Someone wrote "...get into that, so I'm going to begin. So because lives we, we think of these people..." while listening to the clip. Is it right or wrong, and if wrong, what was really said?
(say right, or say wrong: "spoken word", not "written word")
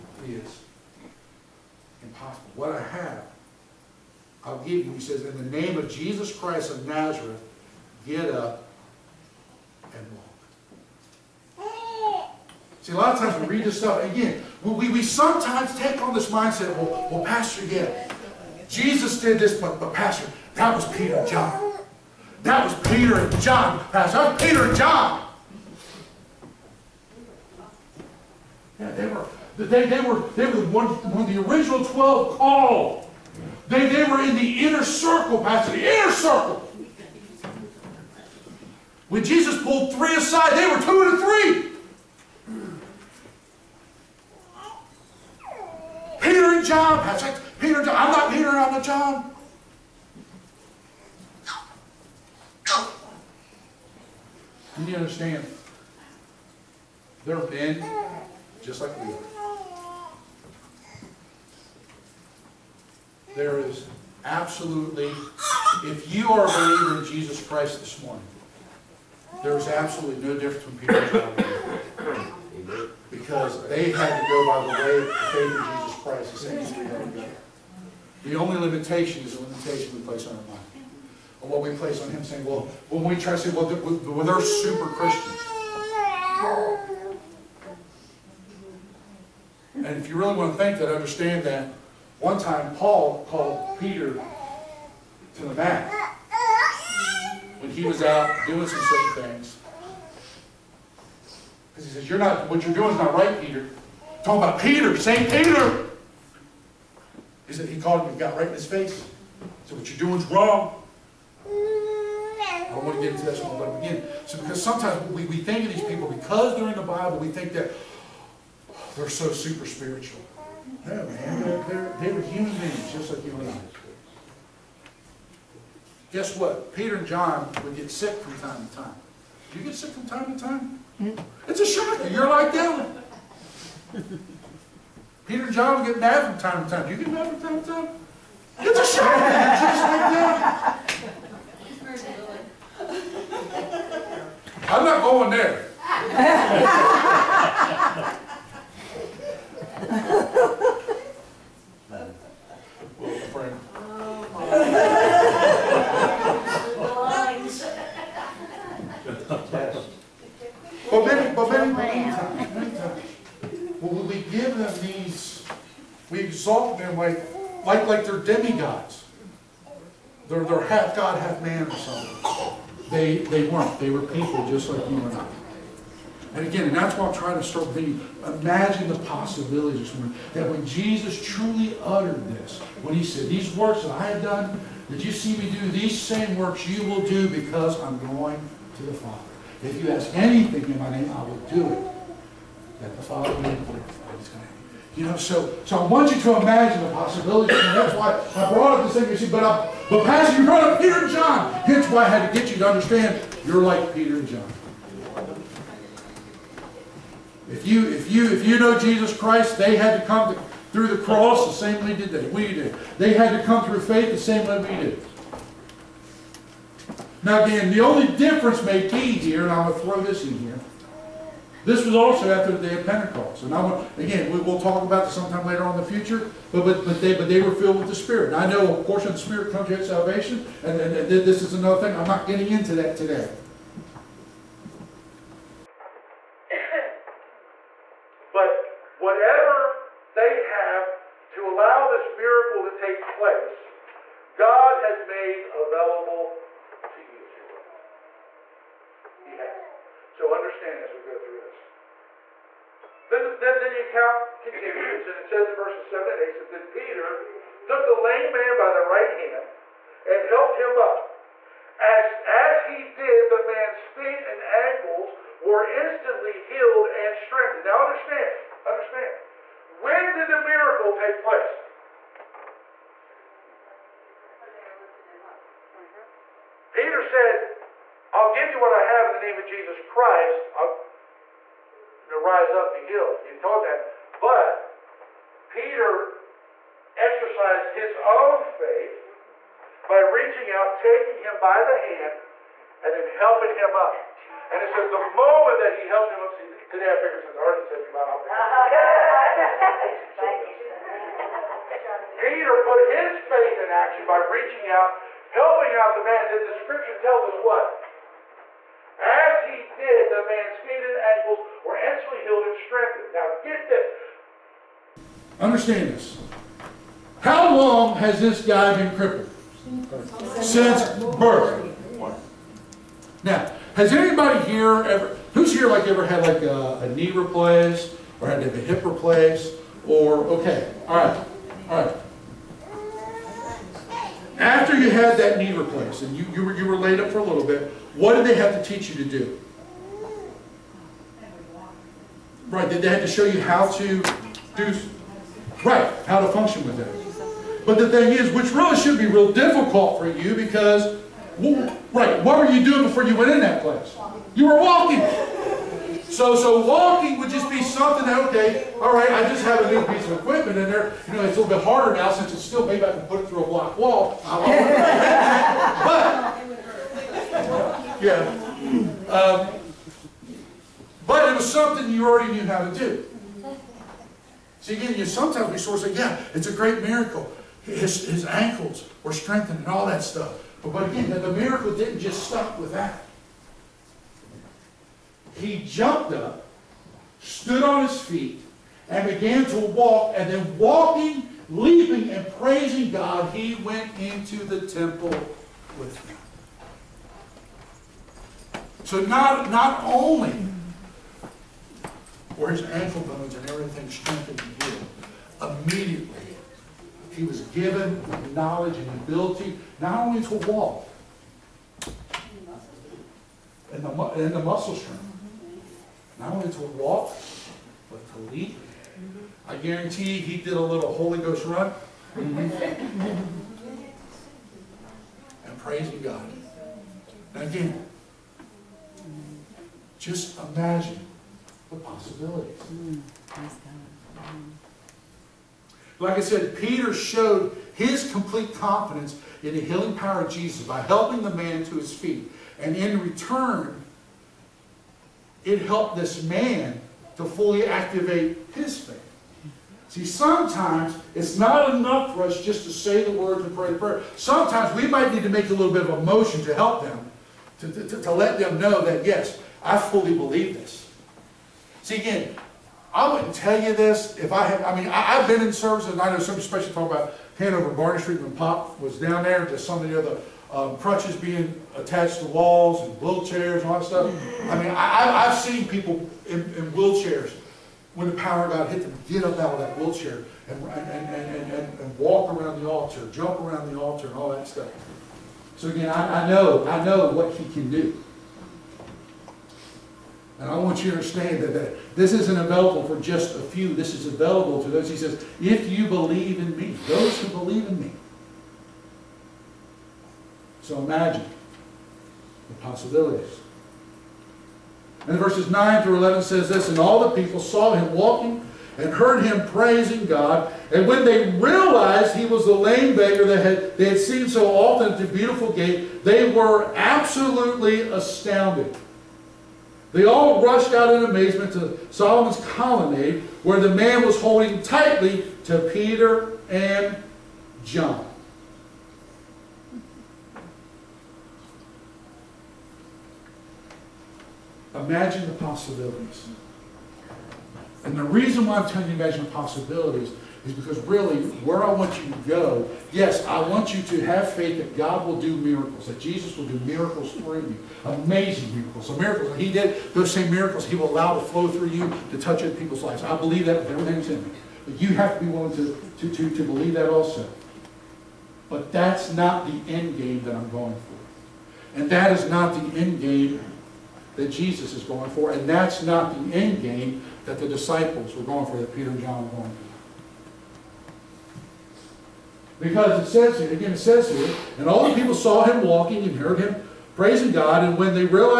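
wrong: "sometimes", not "lives".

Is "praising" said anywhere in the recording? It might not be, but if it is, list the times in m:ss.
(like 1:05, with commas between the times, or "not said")
6:32, 7:05, 8:29, 9:36.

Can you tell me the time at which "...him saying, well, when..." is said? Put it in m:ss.
1:22.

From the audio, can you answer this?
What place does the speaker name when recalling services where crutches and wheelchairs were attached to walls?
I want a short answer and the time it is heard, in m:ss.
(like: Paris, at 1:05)
Hanover Barney Street, at 7:47.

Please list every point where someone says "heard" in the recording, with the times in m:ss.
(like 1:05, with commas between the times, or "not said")
8:28, 9:36.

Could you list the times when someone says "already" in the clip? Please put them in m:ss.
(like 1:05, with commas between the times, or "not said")
4:57, 6:12.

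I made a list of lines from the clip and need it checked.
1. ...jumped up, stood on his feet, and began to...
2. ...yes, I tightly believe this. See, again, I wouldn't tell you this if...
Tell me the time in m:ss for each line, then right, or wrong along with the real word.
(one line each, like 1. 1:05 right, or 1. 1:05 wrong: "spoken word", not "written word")
1. 6:25 right
2. 7:39 wrong: "fully", not "tightly".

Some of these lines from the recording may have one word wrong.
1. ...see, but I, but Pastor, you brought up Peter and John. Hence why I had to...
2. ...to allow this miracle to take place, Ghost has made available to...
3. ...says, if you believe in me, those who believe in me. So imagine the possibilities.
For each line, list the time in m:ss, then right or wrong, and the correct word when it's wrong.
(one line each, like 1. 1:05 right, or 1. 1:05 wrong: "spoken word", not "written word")
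1. 3:19 right
2. 4:01 wrong: "God", not "Ghost"
3. 8:14 right.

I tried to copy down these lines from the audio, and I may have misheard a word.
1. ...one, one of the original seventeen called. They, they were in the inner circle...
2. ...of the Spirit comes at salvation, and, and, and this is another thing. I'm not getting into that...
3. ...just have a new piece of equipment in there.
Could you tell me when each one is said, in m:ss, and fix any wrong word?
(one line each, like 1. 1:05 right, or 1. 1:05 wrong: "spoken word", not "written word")
1. 0:30 wrong: "twelve", not "seventeen"
2. 3:49 right
3. 5:59 right.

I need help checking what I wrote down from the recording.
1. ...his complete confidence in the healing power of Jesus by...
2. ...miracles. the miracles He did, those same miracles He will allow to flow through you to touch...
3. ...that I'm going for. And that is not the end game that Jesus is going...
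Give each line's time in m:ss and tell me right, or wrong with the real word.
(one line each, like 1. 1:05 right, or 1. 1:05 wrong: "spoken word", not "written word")
1. 7:17 right
2. 9:08 right
3. 9:20 right.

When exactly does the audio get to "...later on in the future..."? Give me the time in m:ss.
3:45.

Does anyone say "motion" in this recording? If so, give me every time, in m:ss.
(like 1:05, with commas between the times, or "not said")
7:36.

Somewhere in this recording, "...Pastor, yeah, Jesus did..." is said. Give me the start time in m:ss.
0:17.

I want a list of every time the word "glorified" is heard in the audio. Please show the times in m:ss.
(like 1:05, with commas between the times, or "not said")
3:13.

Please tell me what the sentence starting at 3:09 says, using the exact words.
If you ask anything in my name, I will do it.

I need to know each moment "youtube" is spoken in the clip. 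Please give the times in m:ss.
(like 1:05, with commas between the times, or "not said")
not said.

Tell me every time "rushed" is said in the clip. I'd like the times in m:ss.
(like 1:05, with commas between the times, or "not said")
8:40.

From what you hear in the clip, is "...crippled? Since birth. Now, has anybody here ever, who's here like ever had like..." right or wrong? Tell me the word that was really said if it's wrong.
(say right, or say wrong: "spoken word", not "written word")
right.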